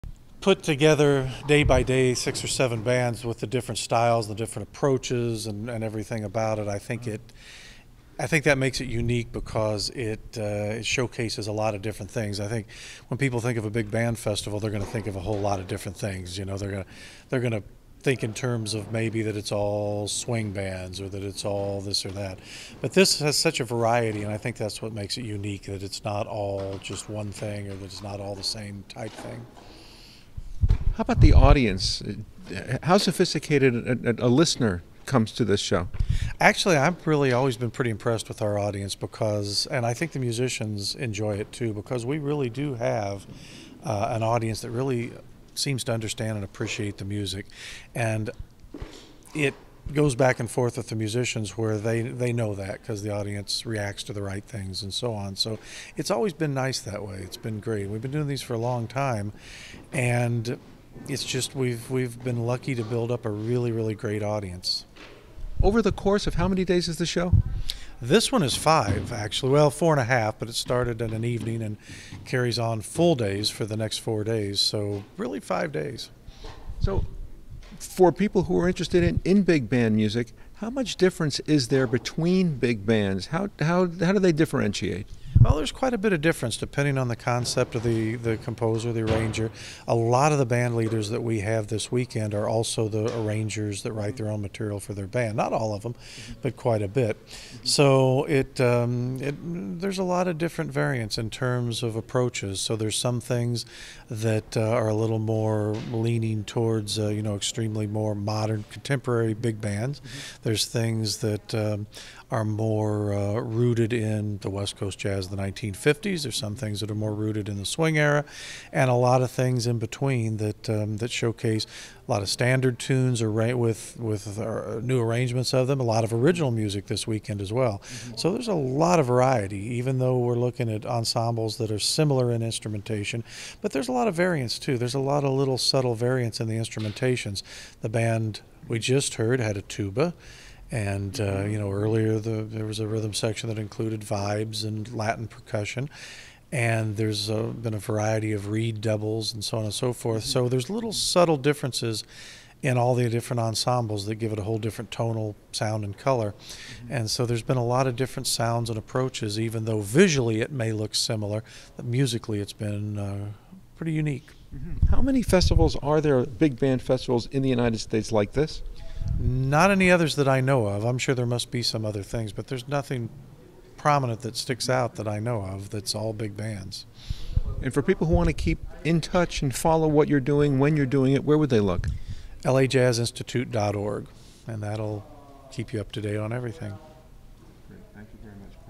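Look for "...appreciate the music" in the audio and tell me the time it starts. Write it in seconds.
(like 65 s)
46 s.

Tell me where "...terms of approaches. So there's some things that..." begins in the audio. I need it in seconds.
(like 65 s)
101 s.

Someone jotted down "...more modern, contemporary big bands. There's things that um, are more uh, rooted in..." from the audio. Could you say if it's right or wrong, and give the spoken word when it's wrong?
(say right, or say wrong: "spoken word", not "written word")
right.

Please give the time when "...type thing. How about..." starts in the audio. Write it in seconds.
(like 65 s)
28 s.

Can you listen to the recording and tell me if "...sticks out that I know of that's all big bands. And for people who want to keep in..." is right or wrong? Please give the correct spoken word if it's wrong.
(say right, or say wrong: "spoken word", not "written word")
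right.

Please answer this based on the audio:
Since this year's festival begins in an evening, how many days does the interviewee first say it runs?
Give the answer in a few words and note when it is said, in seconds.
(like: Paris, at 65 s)
4.5, at 69 s.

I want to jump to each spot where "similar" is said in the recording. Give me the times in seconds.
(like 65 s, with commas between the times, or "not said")
131 s, 160 s.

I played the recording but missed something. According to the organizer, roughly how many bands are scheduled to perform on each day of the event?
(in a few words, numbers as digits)
6 or 7.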